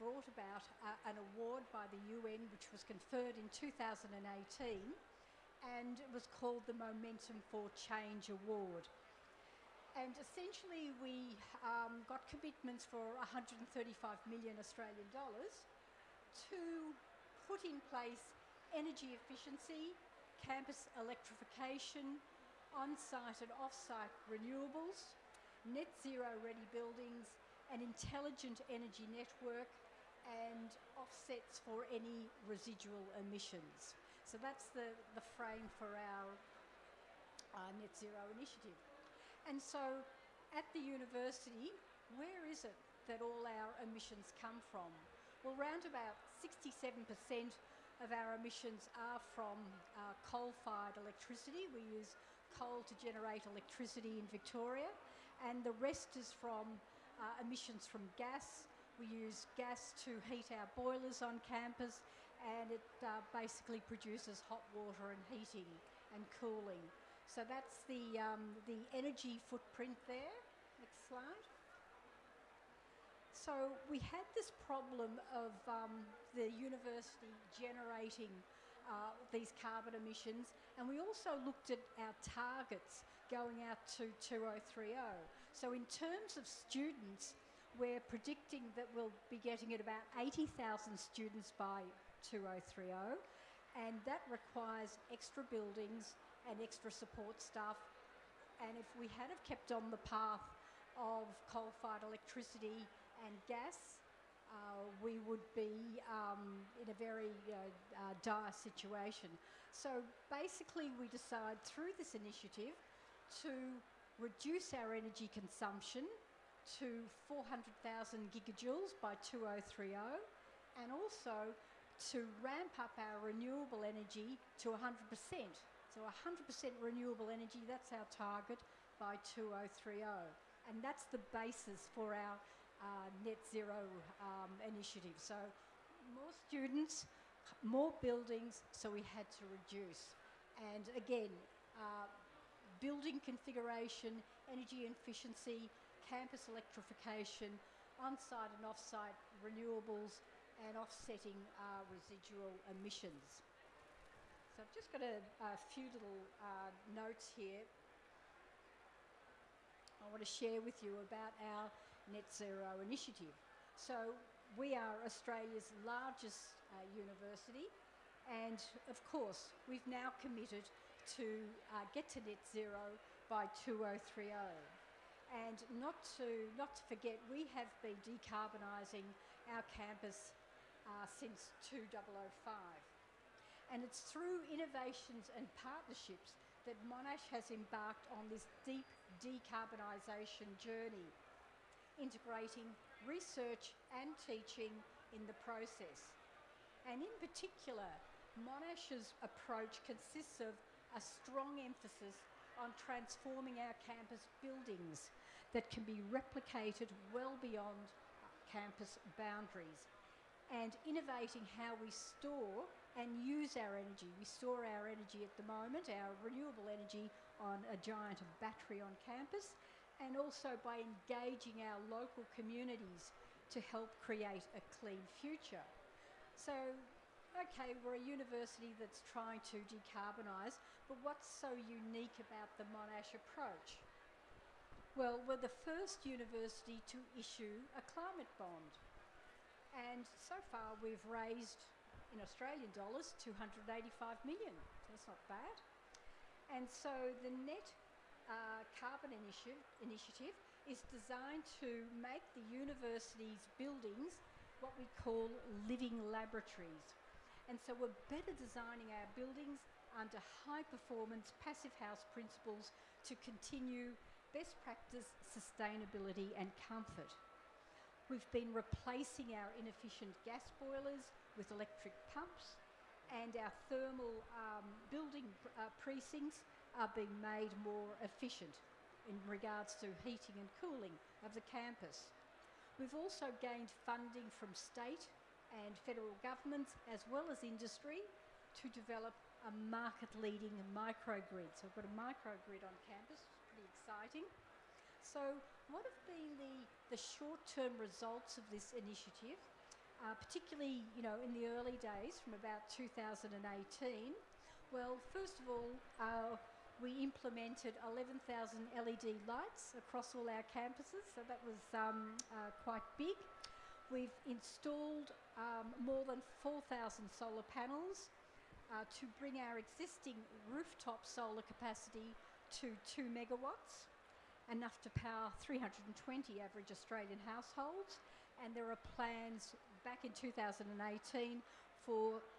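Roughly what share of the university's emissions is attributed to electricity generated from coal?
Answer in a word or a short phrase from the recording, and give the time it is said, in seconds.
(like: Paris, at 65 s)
67%, at 46 s.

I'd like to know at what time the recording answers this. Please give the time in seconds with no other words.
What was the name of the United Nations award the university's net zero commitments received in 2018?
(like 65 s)
6 s.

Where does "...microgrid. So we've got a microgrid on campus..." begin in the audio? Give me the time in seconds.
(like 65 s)
290 s.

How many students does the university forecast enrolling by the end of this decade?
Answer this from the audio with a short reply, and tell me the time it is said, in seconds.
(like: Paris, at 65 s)
80,000, at 90 s.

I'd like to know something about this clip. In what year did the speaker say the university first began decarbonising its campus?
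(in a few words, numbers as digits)
2005.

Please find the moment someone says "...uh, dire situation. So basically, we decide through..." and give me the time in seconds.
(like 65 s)
107 s.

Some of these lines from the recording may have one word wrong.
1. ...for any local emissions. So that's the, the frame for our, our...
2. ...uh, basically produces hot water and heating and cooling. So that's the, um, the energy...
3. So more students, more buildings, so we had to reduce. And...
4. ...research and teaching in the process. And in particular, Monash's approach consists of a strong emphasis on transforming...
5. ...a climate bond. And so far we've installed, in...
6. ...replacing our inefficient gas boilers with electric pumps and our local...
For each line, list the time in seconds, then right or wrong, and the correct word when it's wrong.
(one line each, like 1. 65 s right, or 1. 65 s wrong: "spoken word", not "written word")
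1. 31 s wrong: "residual", not "local"
2. 63 s right
3. 135 s right
4. 193 s right
5. 237 s wrong: "raised", not "installed"
6. 268 s wrong: "thermal", not "local".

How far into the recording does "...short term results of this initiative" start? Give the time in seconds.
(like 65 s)
296 s.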